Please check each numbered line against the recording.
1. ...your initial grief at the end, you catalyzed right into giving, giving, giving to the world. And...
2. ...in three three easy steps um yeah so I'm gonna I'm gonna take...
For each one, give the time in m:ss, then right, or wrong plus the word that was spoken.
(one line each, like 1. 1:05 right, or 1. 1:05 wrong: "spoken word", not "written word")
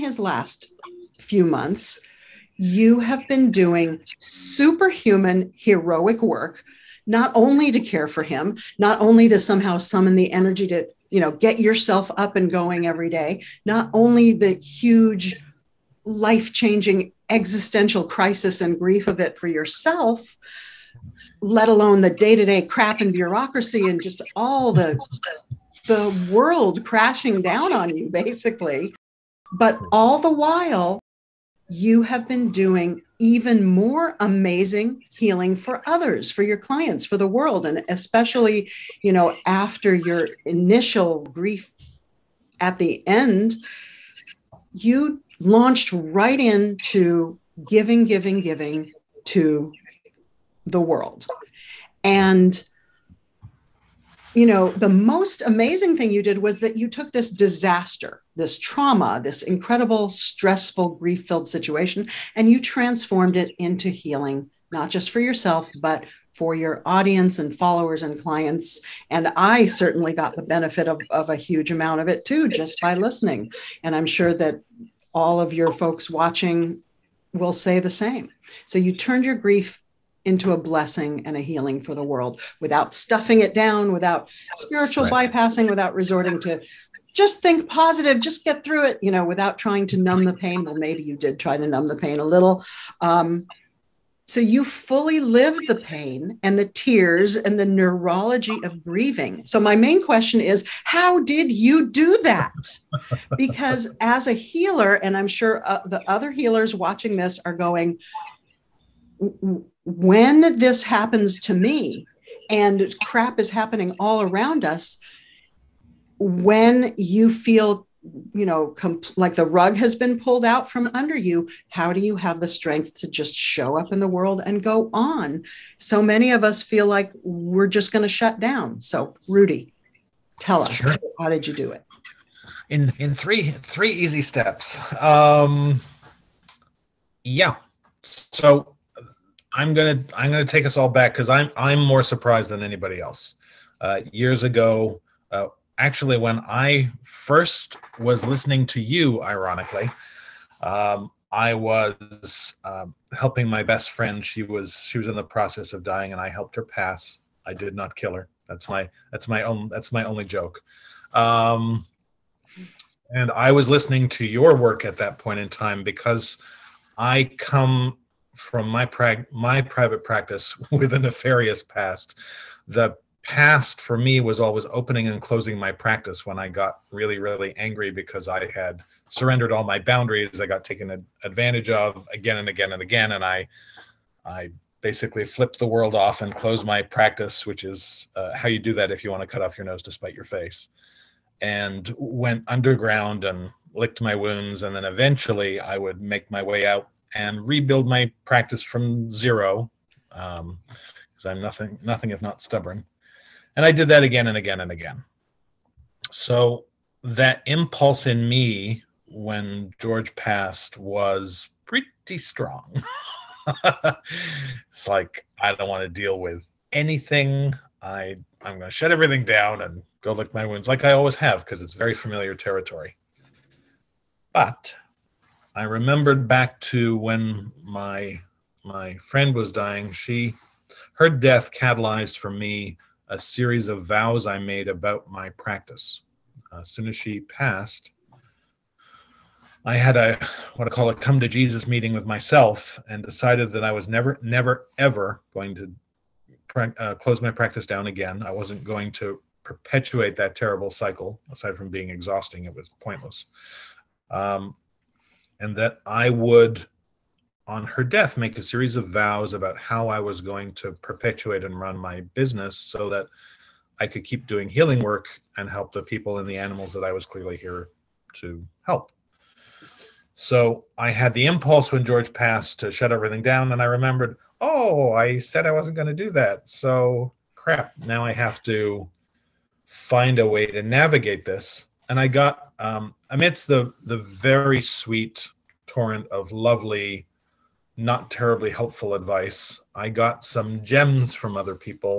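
1. 0:39 wrong: "launched", not "catalyzed"
2. 2:12 right.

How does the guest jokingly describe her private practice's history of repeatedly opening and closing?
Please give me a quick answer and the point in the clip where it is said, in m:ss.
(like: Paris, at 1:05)
a nefarious past, at 2:50.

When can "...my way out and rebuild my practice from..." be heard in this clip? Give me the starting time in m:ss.
3:16.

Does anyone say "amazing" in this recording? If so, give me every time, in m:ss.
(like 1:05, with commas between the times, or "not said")
0:34, 0:55.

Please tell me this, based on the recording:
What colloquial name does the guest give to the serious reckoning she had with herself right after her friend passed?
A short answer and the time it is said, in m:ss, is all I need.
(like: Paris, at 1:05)
come to Jesus meeting, at 4:00.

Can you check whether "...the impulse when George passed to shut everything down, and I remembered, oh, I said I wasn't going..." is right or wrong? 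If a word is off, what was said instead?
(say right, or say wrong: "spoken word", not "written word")
right.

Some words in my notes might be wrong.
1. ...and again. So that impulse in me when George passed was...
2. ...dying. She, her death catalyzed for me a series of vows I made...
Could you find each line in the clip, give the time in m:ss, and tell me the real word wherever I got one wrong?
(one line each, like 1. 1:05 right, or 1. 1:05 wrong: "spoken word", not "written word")
1. 3:24 right
2. 3:49 right.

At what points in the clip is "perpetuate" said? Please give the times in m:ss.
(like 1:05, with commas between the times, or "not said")
4:09, 4:20.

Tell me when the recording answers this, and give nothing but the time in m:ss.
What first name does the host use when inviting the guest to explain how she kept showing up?
2:09.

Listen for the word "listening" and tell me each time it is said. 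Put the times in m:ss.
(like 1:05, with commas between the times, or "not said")
1:12, 2:28, 2:43.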